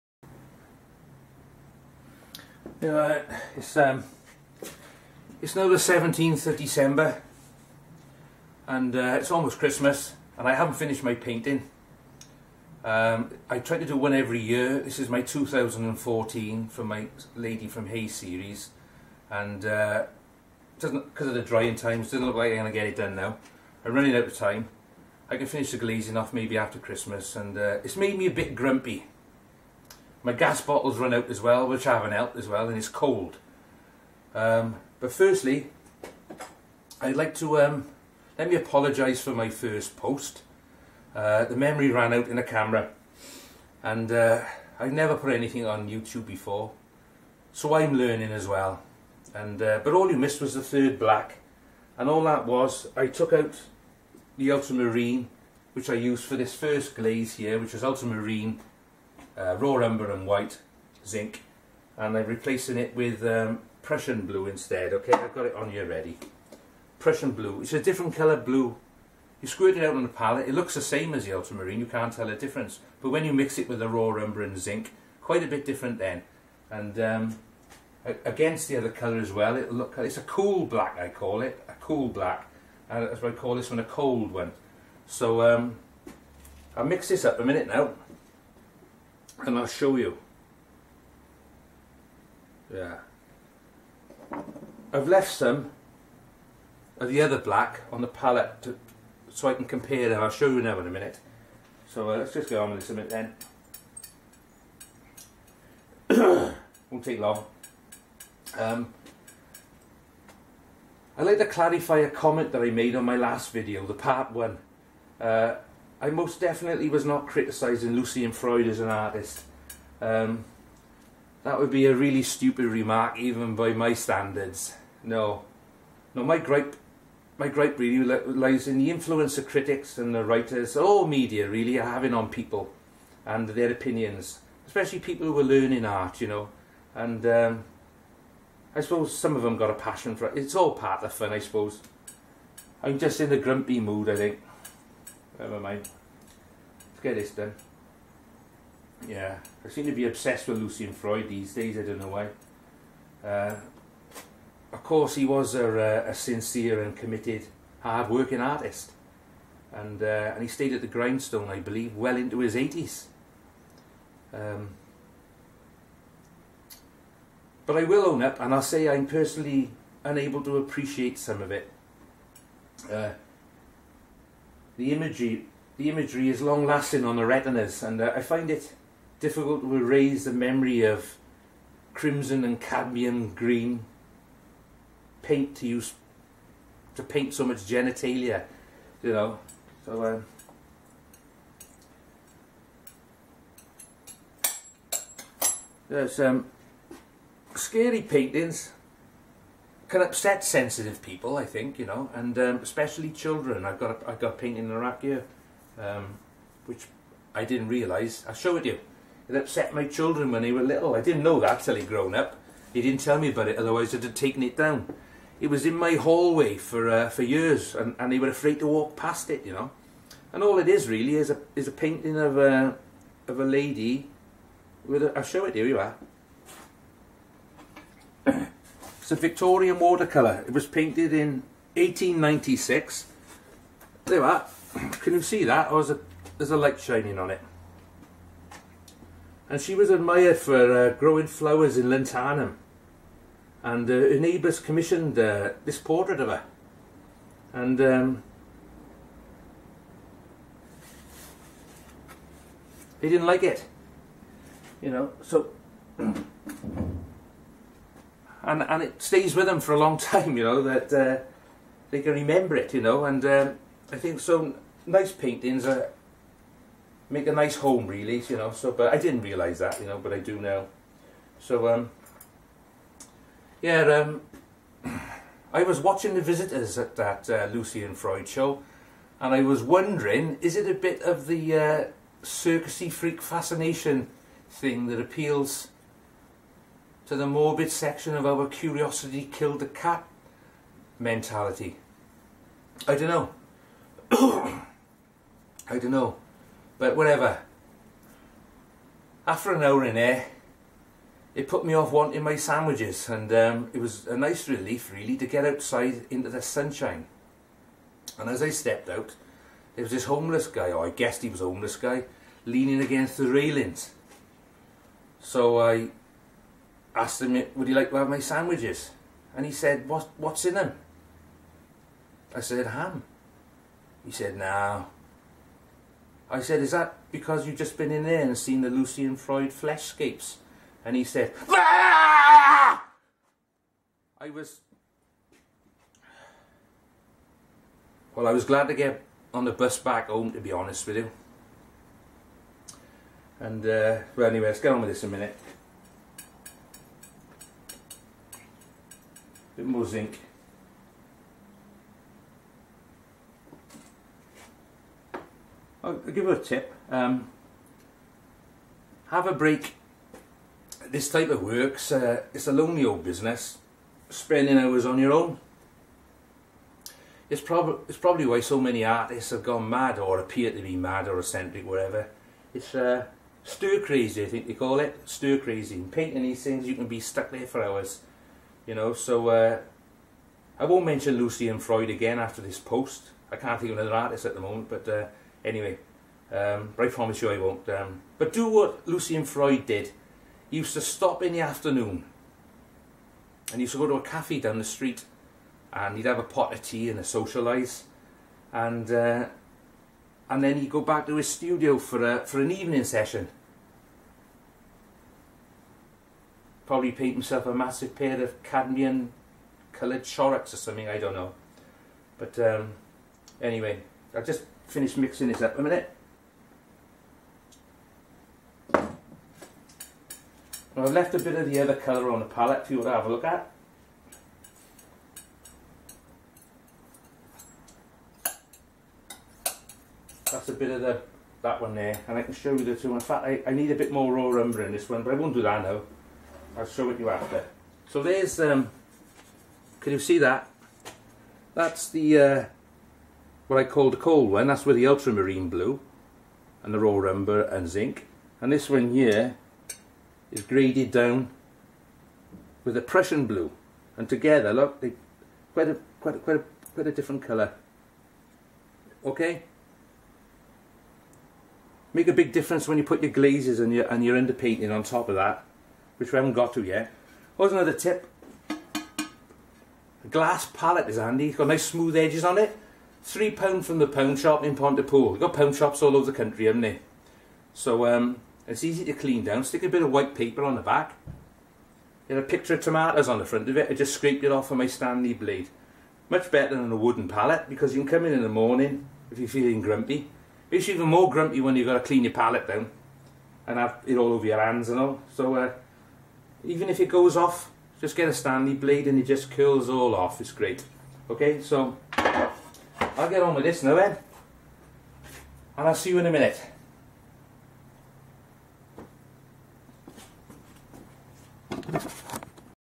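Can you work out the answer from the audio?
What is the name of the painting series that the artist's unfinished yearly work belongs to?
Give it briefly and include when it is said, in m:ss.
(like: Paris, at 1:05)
Lady from Hay, at 0:17.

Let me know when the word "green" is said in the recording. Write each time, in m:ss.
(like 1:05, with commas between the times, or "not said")
3:03.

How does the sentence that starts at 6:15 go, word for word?
painting these things, you can be stuck there for hours.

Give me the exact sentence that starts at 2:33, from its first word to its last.
Uh, of course, he was a, uh, a sincere and committed, hard-working artist.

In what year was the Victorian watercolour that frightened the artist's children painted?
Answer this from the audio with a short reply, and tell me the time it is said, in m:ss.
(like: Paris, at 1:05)
1896, at 3:51.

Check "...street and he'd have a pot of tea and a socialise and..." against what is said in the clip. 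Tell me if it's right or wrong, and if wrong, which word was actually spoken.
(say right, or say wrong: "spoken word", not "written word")
right.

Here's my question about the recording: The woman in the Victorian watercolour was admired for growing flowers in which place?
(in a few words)
Llantanum.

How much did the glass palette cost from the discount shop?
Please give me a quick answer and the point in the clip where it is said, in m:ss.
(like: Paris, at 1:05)
3 pounds, at 7:53.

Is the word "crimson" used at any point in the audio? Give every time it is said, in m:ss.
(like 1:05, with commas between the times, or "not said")
3:01.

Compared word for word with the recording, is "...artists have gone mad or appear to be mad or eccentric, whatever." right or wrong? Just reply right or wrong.
right.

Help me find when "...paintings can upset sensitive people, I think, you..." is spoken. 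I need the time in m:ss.
3:18.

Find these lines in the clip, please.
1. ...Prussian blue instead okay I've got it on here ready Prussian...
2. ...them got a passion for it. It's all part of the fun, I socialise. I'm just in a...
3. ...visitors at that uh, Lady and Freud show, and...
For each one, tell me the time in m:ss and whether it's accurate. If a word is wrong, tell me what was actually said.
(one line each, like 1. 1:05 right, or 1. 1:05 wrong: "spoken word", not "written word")
1. 1:03 right
2. 2:19 wrong: "suppose", not "socialise"
3. 4:36 wrong: "Lucy", not "Lady".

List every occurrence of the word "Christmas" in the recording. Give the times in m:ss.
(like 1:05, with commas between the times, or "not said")
0:09, 0:26.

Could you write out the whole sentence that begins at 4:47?
to the morbid section of our curiosity killed the cat mentality.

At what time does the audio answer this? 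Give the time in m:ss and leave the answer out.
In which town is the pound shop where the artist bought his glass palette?
7:54.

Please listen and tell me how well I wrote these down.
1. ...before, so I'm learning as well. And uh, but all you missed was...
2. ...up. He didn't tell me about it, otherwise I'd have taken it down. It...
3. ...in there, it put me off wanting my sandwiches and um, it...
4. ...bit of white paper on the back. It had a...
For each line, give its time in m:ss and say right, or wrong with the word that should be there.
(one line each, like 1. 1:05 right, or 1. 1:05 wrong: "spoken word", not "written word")
1. 0:46 right
2. 3:32 right
3. 4:59 right
4. 7:59 right.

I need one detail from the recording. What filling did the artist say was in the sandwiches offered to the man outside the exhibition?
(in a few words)
ham.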